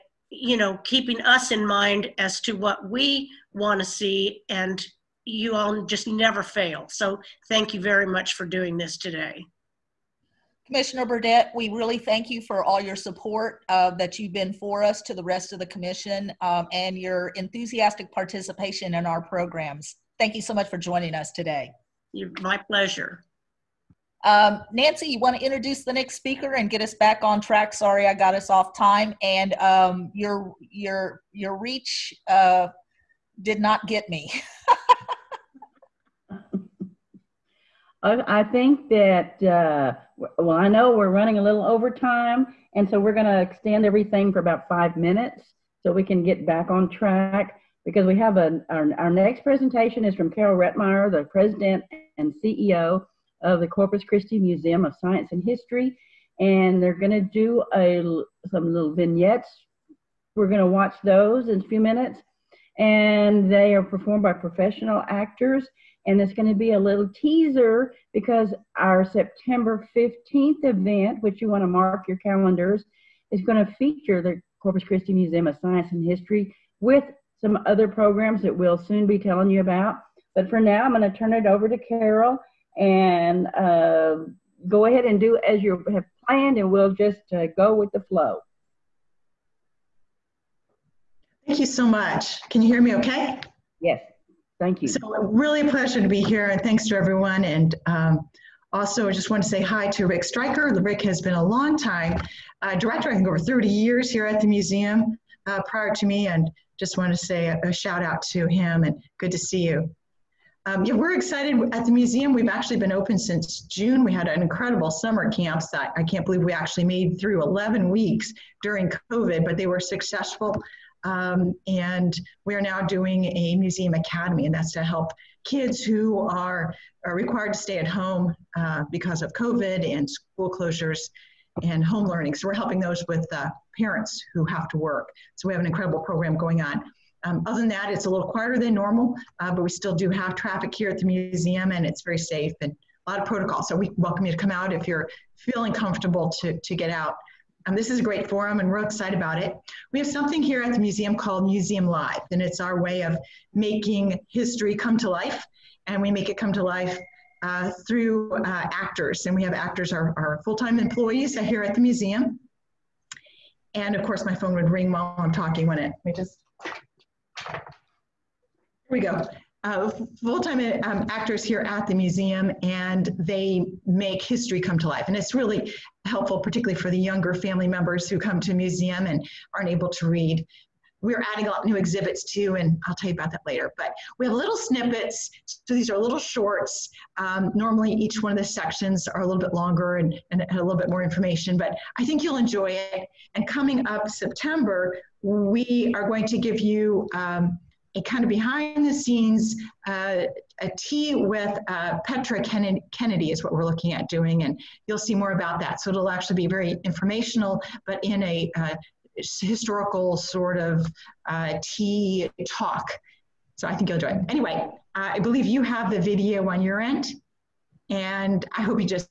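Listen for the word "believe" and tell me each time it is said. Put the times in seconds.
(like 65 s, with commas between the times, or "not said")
116 s, 215 s.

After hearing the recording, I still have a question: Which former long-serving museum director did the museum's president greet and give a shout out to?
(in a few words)
Rick Stryker.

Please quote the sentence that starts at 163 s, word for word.
And of course, my phone would ring while I'm talking, wouldn't it?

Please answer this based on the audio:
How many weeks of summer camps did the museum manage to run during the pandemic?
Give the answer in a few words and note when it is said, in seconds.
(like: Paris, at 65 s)
11, at 117 s.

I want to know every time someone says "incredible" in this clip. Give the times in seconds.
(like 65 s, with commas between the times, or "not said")
114 s, 135 s.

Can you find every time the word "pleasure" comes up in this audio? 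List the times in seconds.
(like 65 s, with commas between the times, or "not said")
22 s, 95 s.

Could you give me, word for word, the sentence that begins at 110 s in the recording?
Um, yeah, we're excited at the museum.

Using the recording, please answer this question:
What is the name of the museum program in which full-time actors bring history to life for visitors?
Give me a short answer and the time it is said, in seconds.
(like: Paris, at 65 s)
Museum Live, at 151 s.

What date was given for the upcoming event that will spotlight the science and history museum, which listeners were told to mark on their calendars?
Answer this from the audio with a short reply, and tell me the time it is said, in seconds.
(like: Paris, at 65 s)
September 15th, at 69 s.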